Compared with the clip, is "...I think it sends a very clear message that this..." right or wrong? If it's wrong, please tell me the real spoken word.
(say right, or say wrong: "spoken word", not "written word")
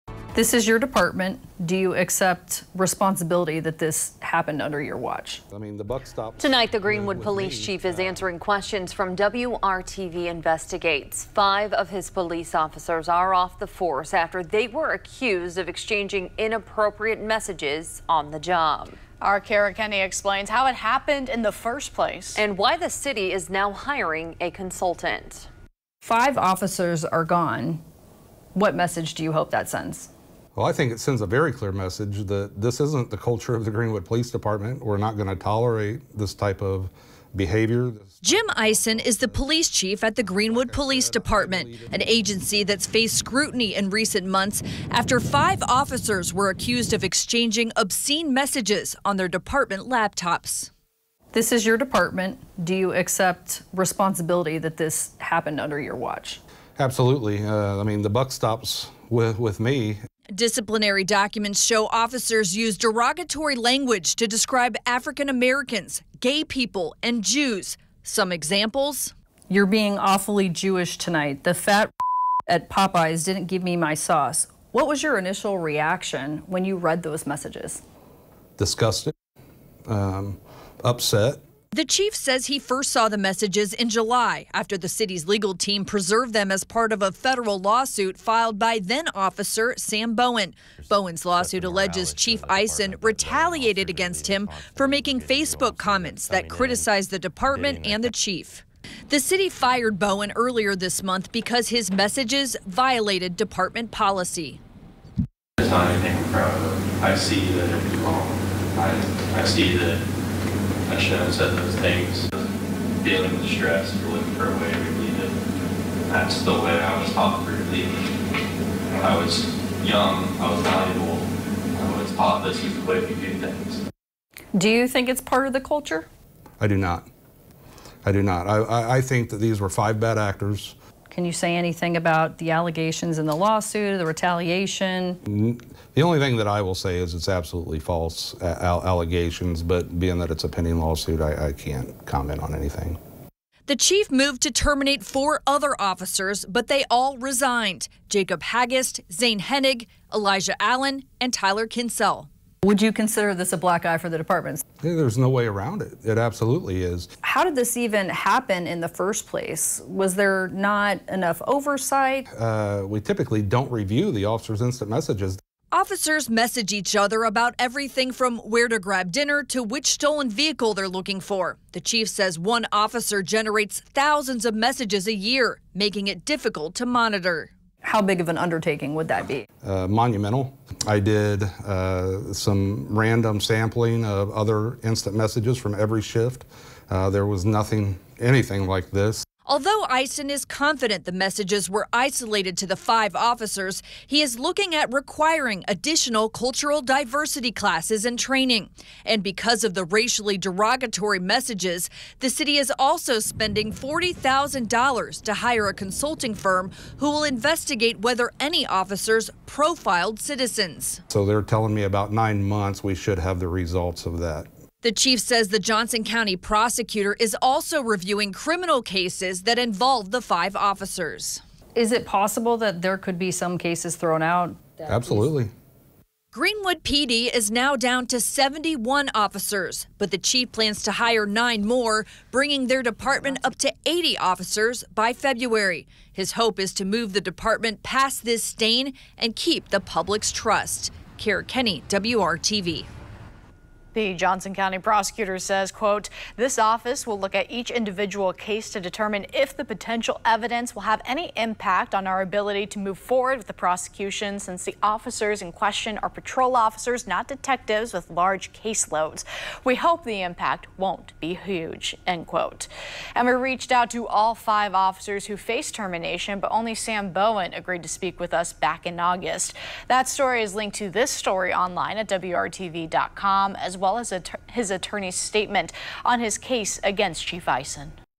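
right.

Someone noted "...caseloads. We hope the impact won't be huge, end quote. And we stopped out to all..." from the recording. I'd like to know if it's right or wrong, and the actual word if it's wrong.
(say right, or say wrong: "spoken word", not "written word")
wrong: "reached", not "stopped".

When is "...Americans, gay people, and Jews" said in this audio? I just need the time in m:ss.
1:05.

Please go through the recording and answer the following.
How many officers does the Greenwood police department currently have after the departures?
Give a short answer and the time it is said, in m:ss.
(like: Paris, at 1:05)
71, at 3:48.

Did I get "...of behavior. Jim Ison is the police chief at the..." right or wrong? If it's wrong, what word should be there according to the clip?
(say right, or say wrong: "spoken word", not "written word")
right.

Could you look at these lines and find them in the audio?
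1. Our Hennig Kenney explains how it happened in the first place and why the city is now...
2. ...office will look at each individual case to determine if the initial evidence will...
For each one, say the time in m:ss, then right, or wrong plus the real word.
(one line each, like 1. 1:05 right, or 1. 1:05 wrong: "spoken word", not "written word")
1. 0:19 wrong: "Kara", not "Hennig"
2. 4:06 wrong: "potential", not "initial".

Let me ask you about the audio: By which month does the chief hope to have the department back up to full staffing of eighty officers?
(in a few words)
February.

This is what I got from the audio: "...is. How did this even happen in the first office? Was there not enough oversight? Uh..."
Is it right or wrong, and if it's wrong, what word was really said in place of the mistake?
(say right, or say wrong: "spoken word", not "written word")
wrong: "place", not "office".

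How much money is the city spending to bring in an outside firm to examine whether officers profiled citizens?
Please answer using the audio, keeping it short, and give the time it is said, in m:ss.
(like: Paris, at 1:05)
$40,000, at 3:23.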